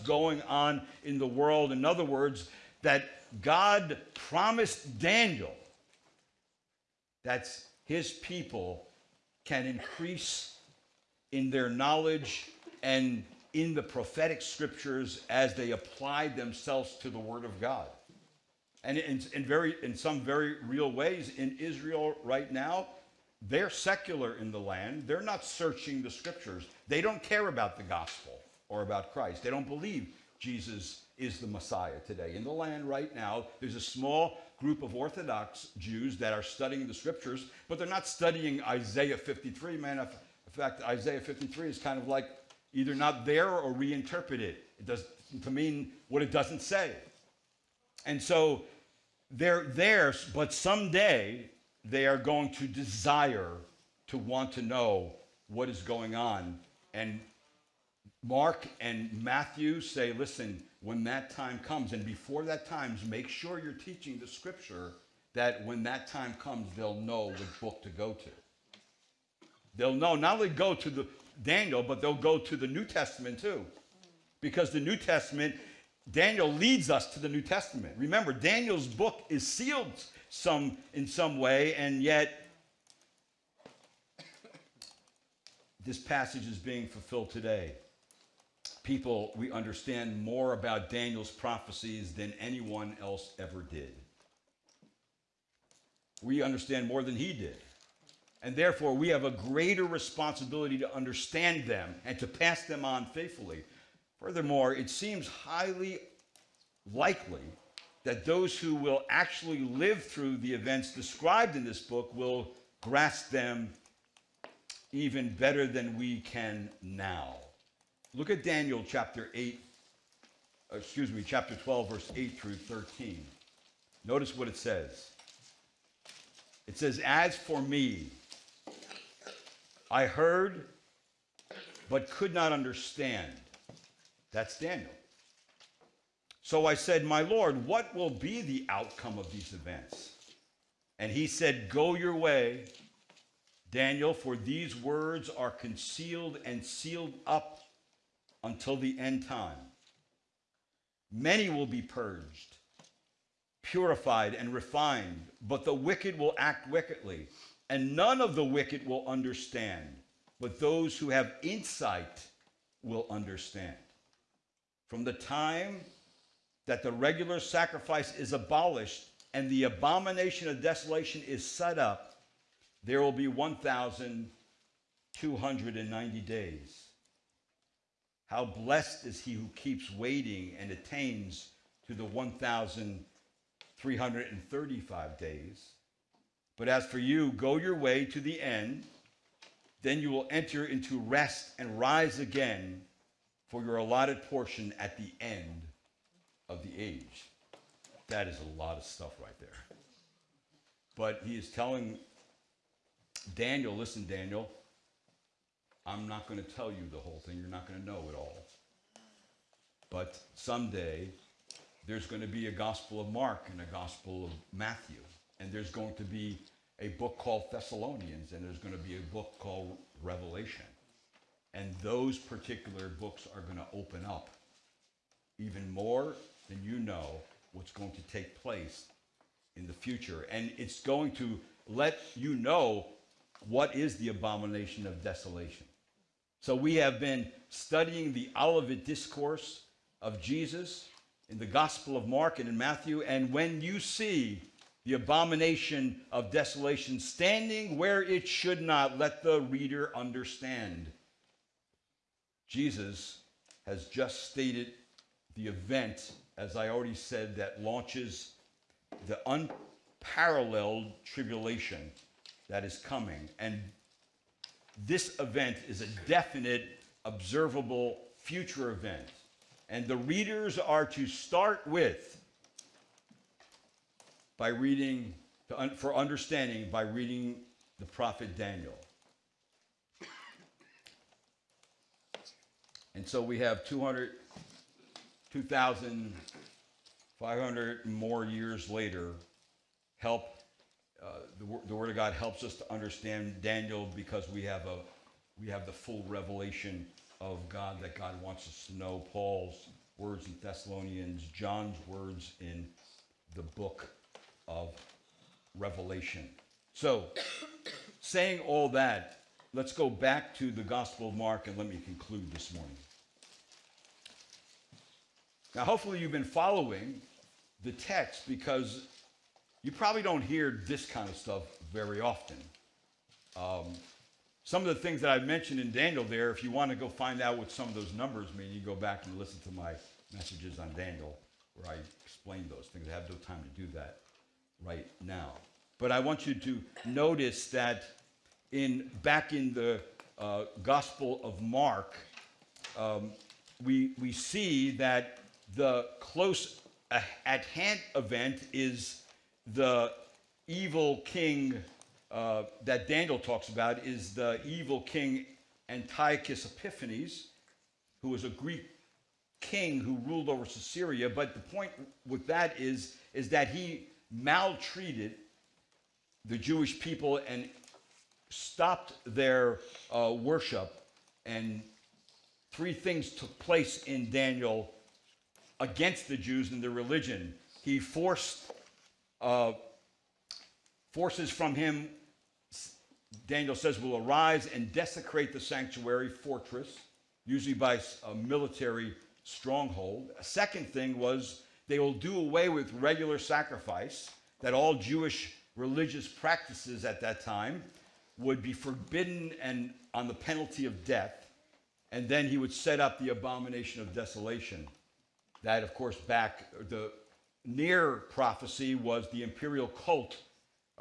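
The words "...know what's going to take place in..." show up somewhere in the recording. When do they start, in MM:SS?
03:46.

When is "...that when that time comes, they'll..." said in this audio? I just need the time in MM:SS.
01:05.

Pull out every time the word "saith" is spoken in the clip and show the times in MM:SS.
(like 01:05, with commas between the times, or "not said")
not said.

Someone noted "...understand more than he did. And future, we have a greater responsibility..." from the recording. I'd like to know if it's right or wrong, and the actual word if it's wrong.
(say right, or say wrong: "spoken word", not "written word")
wrong: "therefore", not "future".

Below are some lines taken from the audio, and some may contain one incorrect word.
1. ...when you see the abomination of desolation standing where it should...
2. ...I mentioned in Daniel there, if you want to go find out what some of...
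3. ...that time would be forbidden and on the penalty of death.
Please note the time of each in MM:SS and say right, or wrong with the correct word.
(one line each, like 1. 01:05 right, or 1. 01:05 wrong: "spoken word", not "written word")
1. 04:03 right
2. 05:25 right
3. 06:37 right.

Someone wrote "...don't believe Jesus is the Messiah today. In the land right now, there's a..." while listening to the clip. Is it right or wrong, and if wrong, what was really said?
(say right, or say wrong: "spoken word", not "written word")
right.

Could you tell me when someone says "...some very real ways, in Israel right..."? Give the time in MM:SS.
00:19.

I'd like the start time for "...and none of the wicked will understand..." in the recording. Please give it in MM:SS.
02:37.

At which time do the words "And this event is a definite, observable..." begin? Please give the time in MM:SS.
04:23.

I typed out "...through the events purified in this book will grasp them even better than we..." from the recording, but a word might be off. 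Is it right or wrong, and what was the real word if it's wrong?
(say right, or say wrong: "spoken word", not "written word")
wrong: "described", not "purified".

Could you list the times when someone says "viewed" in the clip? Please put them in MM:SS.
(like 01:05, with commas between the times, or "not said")
not said.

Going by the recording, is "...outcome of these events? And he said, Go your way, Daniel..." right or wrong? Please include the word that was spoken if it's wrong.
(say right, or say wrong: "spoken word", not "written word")
right.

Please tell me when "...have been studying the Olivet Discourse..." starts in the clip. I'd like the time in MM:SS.
03:56.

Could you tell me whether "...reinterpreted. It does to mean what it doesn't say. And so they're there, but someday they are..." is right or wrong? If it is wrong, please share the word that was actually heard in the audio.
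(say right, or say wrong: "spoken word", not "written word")
right.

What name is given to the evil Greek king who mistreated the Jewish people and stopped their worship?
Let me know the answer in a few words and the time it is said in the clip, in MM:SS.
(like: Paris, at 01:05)
Antiochus Epiphanes, at 05:55.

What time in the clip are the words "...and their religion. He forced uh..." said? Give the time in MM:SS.
06:16.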